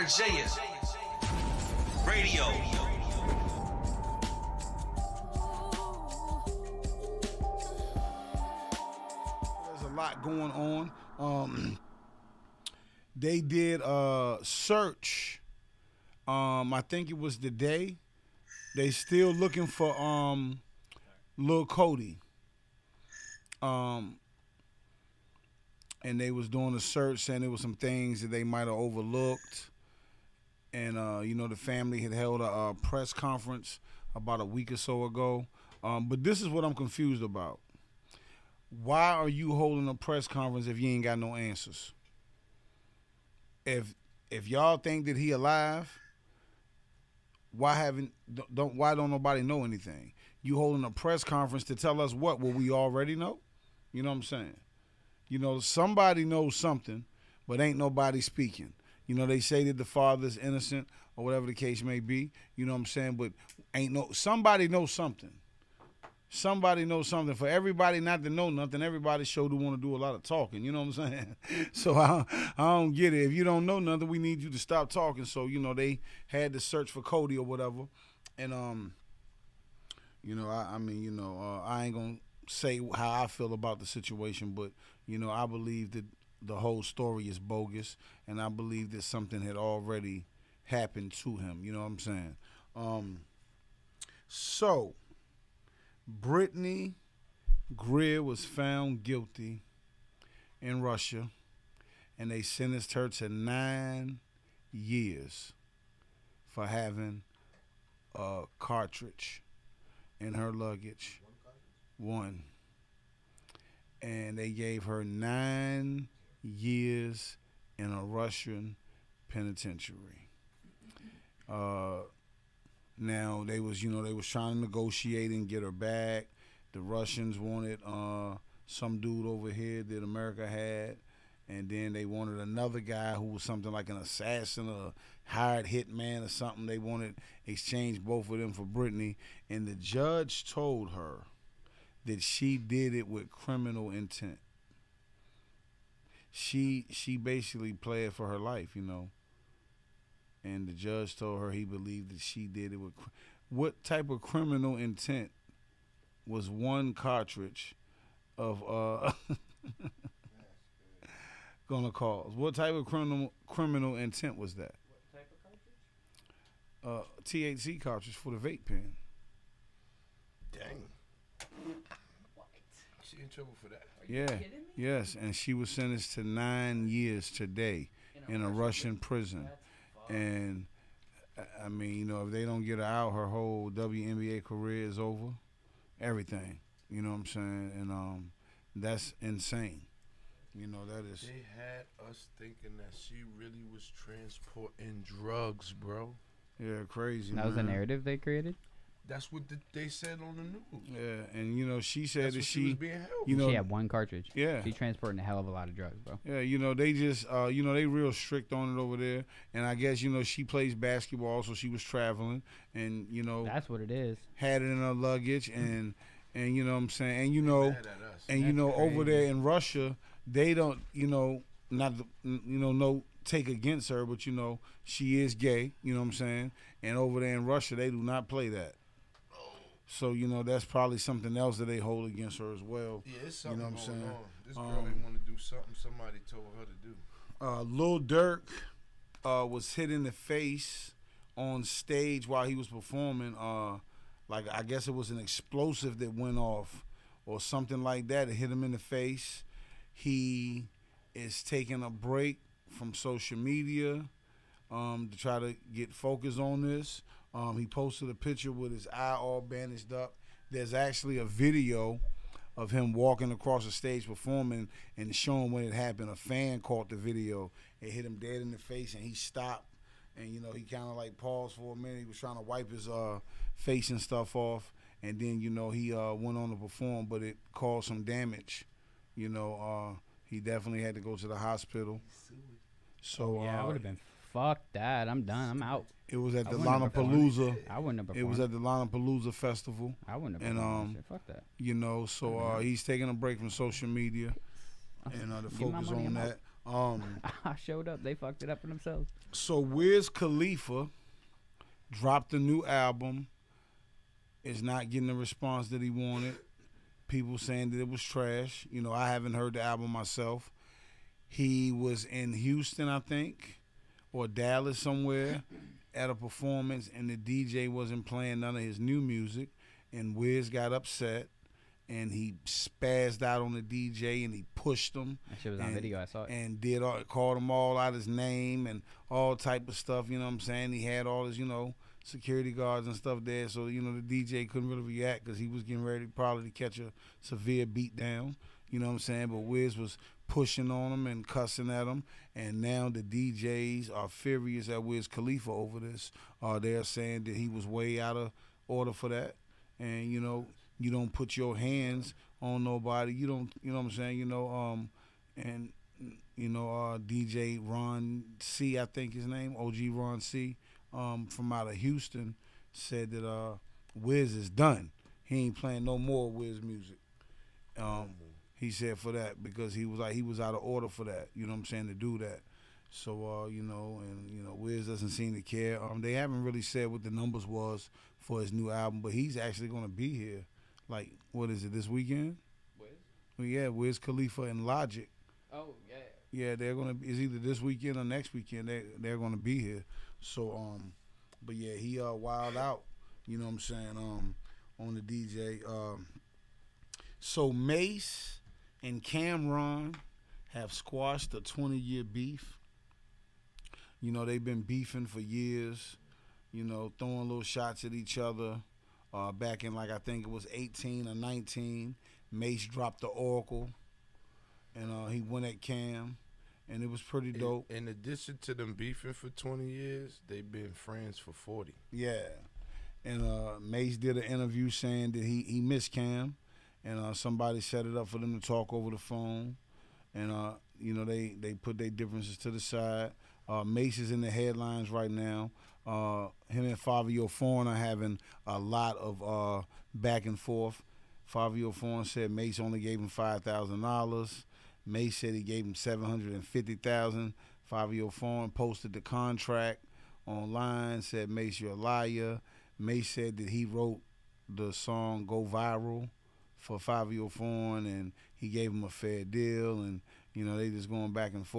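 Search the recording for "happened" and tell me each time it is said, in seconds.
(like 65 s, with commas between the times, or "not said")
90 s, 265 s.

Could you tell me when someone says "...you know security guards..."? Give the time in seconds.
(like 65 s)
331 s.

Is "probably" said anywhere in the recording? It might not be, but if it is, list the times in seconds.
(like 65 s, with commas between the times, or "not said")
230 s, 336 s.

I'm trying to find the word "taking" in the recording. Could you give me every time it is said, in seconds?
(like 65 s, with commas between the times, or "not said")
251 s, 292 s.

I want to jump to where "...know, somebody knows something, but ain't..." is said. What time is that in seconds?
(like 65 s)
55 s.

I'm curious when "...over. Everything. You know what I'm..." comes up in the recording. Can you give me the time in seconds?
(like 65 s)
184 s.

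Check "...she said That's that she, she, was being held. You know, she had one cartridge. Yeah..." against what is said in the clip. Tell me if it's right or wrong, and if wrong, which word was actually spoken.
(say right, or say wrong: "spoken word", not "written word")
right.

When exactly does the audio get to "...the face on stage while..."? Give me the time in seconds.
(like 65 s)
240 s.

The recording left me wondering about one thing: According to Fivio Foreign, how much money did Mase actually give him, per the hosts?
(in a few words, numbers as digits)
$5,000.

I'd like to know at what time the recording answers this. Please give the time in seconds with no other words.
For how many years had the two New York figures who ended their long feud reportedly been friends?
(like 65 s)
421 s.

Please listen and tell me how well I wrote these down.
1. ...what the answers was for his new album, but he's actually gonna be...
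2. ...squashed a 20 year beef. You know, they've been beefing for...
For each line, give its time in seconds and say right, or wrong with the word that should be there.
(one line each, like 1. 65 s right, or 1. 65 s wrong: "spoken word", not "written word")
1. 376 s wrong: "numbers", not "answers"
2. 400 s right.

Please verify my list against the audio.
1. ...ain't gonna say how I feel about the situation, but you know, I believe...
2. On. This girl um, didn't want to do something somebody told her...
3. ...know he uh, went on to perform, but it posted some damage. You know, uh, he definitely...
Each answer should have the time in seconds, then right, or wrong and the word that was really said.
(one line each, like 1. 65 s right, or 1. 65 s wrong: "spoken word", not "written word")
1. 81 s right
2. 234 s right
3. 275 s wrong: "caused", not "posted".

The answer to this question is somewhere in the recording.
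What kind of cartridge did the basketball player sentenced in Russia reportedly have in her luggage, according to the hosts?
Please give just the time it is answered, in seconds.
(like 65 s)
167 s.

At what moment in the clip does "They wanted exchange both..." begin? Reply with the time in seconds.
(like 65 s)
136 s.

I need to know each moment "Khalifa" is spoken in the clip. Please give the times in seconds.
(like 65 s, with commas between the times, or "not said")
300 s, 345 s, 383 s.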